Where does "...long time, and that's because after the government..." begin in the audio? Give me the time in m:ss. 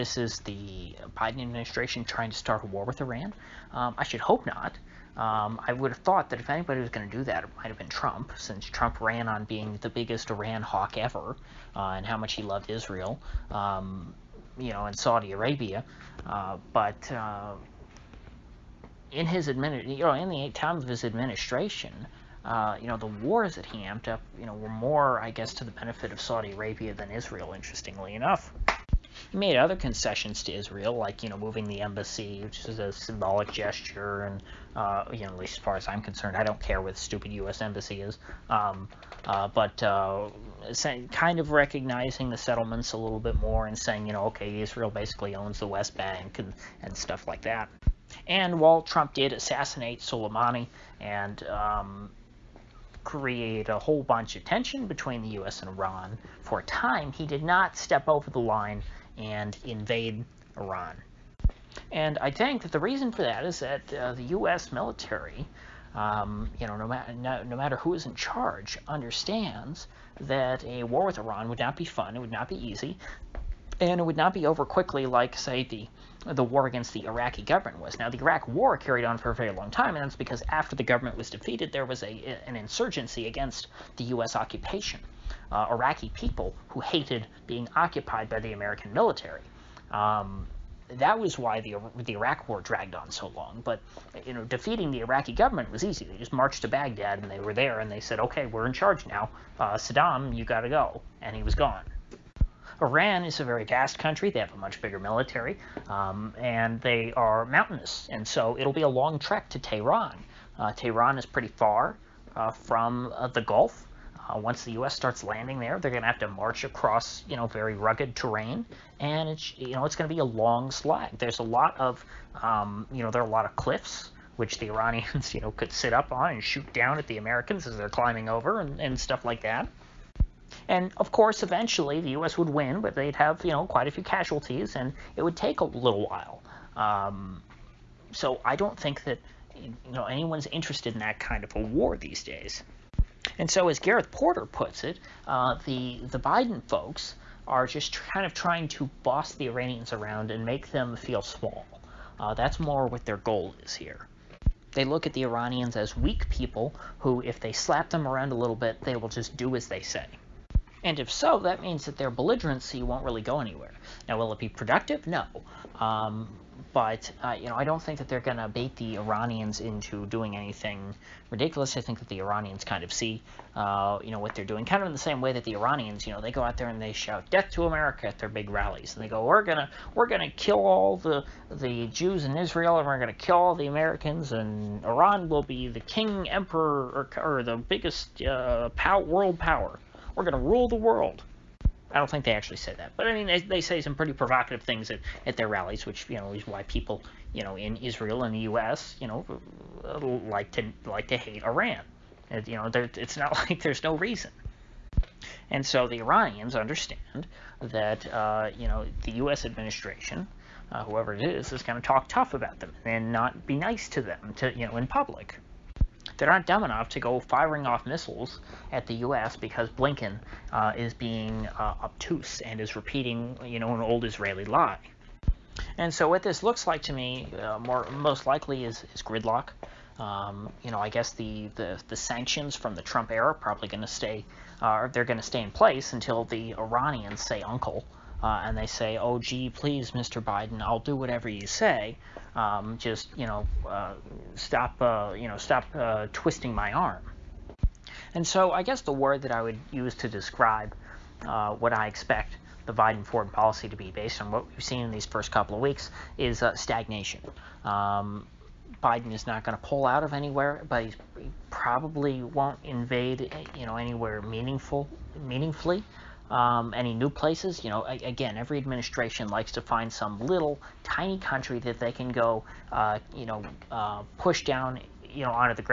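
1:19.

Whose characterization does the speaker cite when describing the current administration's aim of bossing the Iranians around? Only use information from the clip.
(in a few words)
Gareth Porter.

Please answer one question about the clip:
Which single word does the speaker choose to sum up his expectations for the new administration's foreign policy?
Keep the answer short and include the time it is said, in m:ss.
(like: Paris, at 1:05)
stagnation, at 4:16.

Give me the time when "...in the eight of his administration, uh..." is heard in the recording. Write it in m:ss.
0:20.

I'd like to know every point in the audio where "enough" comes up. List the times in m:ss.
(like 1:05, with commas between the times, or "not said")
0:28, 3:36.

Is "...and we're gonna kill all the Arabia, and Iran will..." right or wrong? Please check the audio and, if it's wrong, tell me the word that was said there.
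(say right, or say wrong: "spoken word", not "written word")
wrong: "Americans", not "Arabia".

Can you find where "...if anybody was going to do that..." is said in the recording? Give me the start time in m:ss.
0:06.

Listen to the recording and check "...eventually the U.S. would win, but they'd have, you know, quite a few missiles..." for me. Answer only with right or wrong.
wrong.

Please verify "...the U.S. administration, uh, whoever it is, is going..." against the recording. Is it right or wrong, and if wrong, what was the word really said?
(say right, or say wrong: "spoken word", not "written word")
right.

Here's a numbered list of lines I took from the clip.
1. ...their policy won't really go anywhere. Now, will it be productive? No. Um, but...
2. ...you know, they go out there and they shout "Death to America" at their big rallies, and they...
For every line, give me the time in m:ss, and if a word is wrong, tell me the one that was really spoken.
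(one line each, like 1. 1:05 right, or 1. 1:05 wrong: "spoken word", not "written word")
1. 2:41 wrong: "belligerency", not "policy"
2. 2:56 right.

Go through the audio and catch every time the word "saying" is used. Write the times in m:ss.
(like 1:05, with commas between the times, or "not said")
0:43.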